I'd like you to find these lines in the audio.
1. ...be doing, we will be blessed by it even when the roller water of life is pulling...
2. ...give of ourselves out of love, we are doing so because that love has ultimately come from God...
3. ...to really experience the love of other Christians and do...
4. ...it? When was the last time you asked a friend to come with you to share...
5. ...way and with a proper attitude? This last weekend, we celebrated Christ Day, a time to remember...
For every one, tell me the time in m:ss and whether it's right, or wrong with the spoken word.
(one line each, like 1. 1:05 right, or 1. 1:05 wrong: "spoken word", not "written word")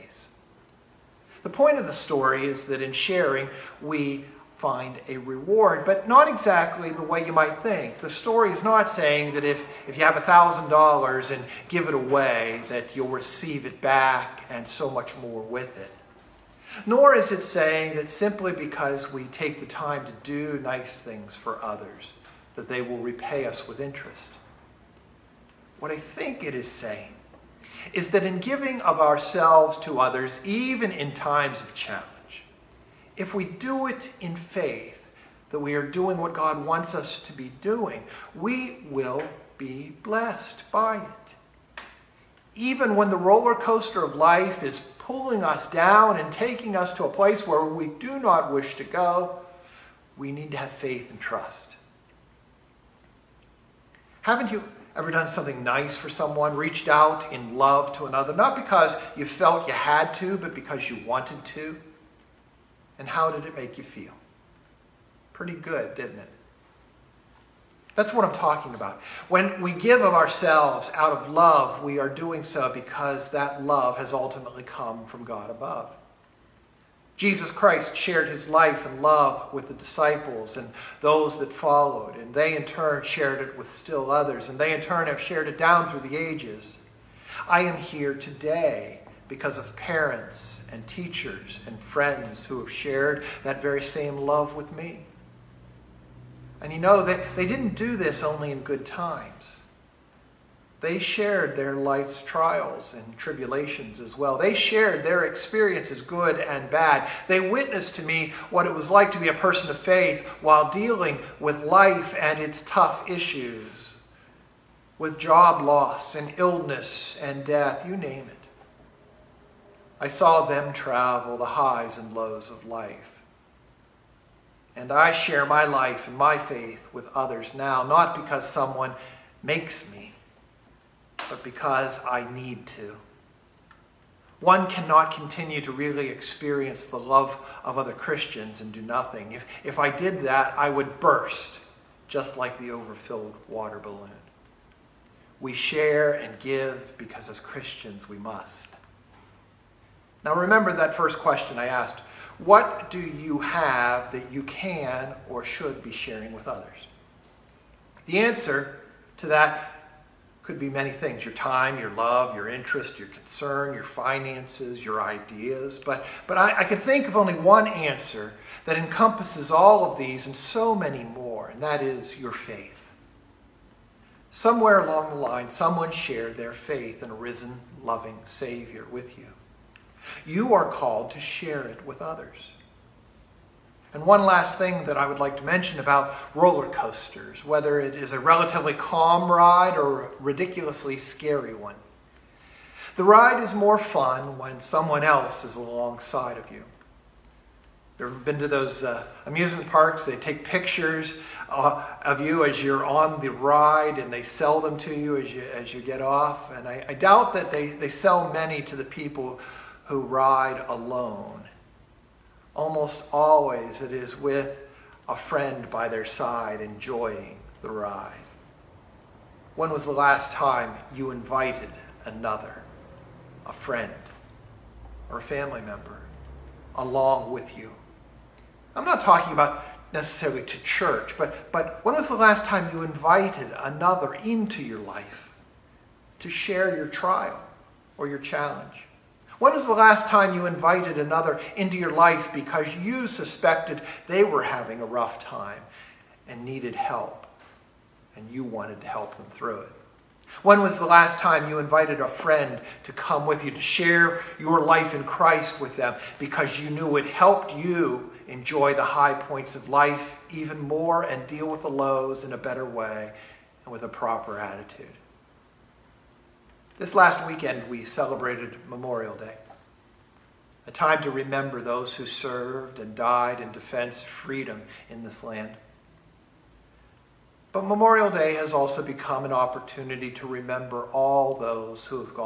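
1. 0:37 wrong: "coaster", not "water"
2. 1:09 right
3. 2:15 right
4. 4:09 wrong: "invited", not "asked"
5. 4:22 wrong: "Memorial", not "Christ".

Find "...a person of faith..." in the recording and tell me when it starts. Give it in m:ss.
1:49.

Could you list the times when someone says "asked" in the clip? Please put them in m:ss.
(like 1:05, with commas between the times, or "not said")
2:31.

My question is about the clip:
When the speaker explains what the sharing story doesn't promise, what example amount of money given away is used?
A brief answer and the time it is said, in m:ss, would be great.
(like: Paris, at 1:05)
$1,000, at 0:10.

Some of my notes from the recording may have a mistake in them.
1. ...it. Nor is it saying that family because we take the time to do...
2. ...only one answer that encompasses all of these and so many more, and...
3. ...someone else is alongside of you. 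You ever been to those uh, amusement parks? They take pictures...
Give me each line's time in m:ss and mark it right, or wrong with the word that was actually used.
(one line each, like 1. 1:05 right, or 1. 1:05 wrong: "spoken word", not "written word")
1. 0:15 wrong: "simply", not "family"
2. 2:47 right
3. 3:14 right.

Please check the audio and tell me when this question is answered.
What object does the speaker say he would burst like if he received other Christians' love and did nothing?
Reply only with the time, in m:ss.
2:22.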